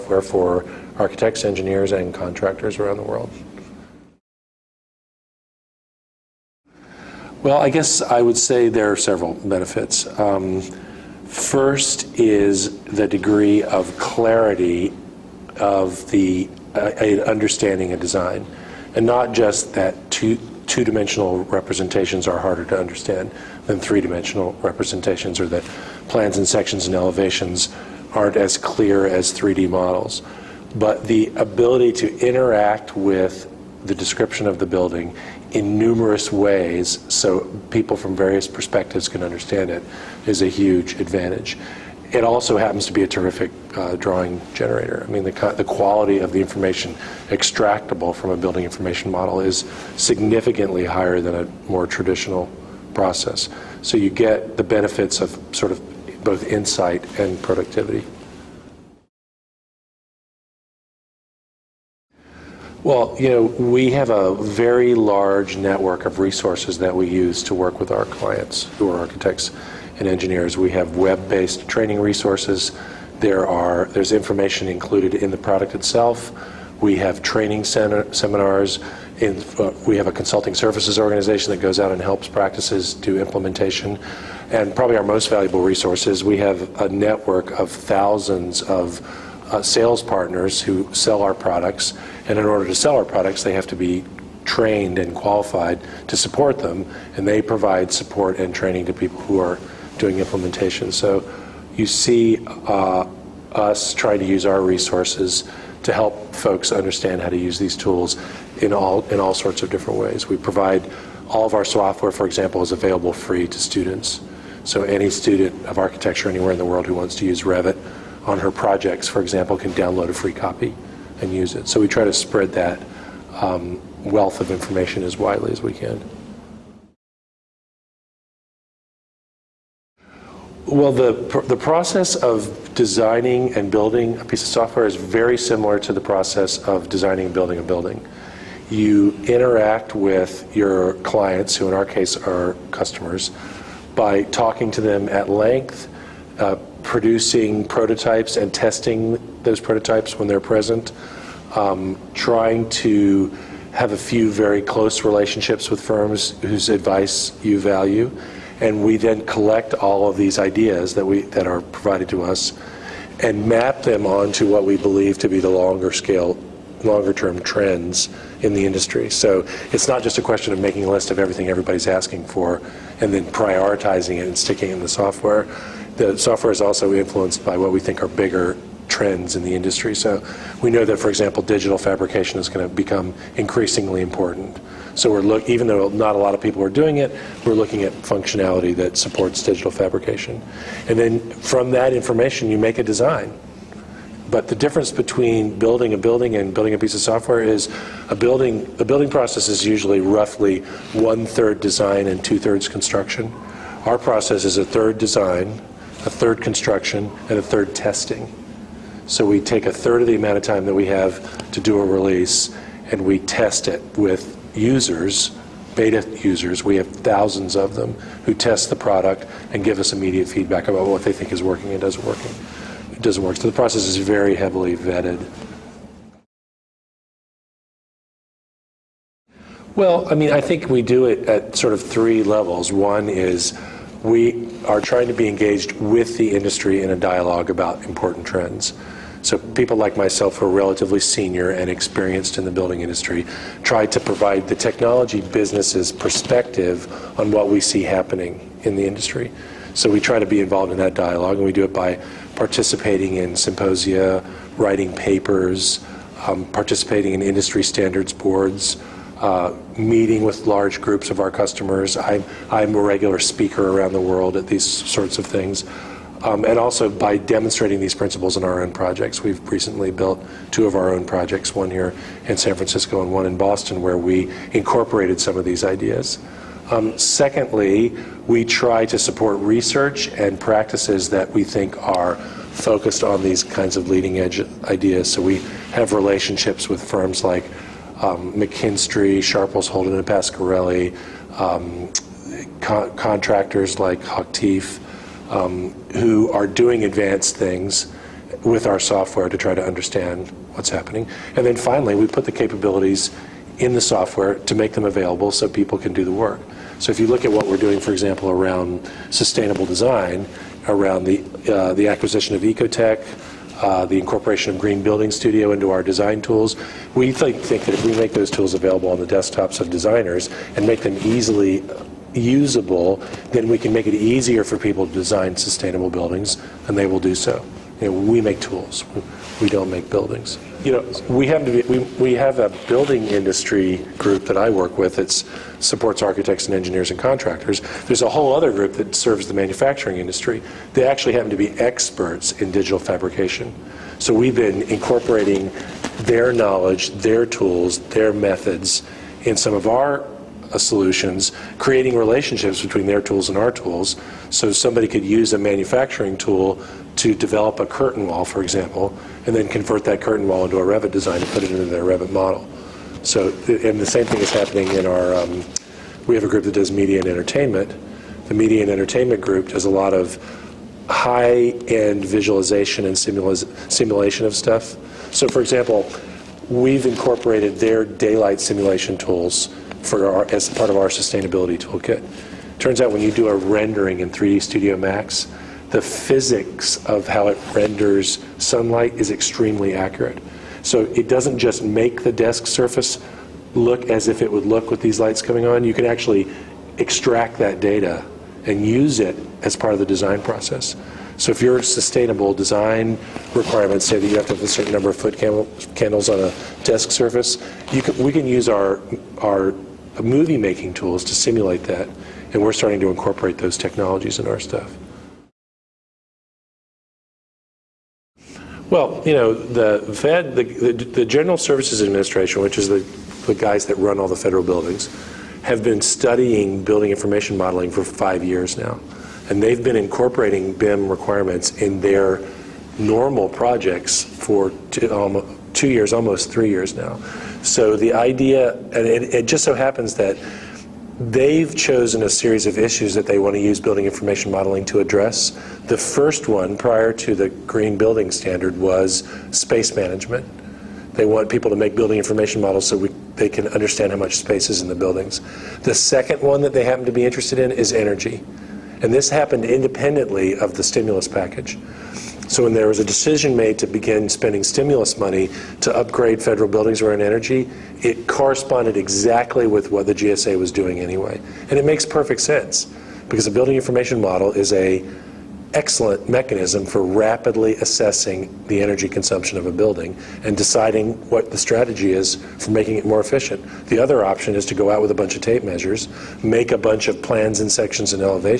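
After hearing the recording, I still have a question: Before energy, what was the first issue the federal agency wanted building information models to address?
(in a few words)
Space management.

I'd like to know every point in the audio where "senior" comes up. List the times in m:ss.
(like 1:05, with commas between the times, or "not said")
4:01.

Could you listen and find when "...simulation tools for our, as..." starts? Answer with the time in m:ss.
6:18.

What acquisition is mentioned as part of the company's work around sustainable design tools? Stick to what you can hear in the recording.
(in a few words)
Ecotect.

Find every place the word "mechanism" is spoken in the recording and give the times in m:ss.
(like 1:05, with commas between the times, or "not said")
7:56.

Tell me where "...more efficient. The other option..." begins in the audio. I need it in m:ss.
8:02.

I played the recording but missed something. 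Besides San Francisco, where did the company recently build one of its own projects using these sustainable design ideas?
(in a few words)
Boston.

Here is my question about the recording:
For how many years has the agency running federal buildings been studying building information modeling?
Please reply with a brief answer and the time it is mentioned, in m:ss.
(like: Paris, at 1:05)
5 years, at 7:07.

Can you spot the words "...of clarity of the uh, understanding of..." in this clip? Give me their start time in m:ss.
0:13.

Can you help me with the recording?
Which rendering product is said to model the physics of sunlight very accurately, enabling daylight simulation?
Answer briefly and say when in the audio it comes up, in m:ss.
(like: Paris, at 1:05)
3D Studio Max, at 6:24.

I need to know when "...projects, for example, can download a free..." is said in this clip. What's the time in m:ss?
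1:58.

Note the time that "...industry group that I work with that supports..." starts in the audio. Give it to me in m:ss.
5:33.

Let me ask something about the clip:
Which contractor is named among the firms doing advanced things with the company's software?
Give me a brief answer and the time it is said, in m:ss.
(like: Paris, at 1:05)
Hochtief, at 4:54.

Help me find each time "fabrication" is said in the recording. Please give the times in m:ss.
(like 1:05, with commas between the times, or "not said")
3:01, 3:09, 5:42.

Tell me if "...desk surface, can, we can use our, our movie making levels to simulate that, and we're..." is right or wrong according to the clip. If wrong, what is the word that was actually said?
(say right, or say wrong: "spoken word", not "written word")
wrong: "tools", not "levels".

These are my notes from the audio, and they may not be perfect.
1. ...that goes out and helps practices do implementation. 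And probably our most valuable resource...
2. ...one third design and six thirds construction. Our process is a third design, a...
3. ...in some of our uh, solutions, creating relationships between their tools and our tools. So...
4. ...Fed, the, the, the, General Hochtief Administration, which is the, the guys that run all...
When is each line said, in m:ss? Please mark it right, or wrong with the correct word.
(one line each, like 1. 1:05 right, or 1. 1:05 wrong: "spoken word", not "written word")
1. 1:21 right
2. 3:20 wrong: "two", not "six"
3. 5:49 right
4. 6:59 wrong: "Services", not "Hochtief".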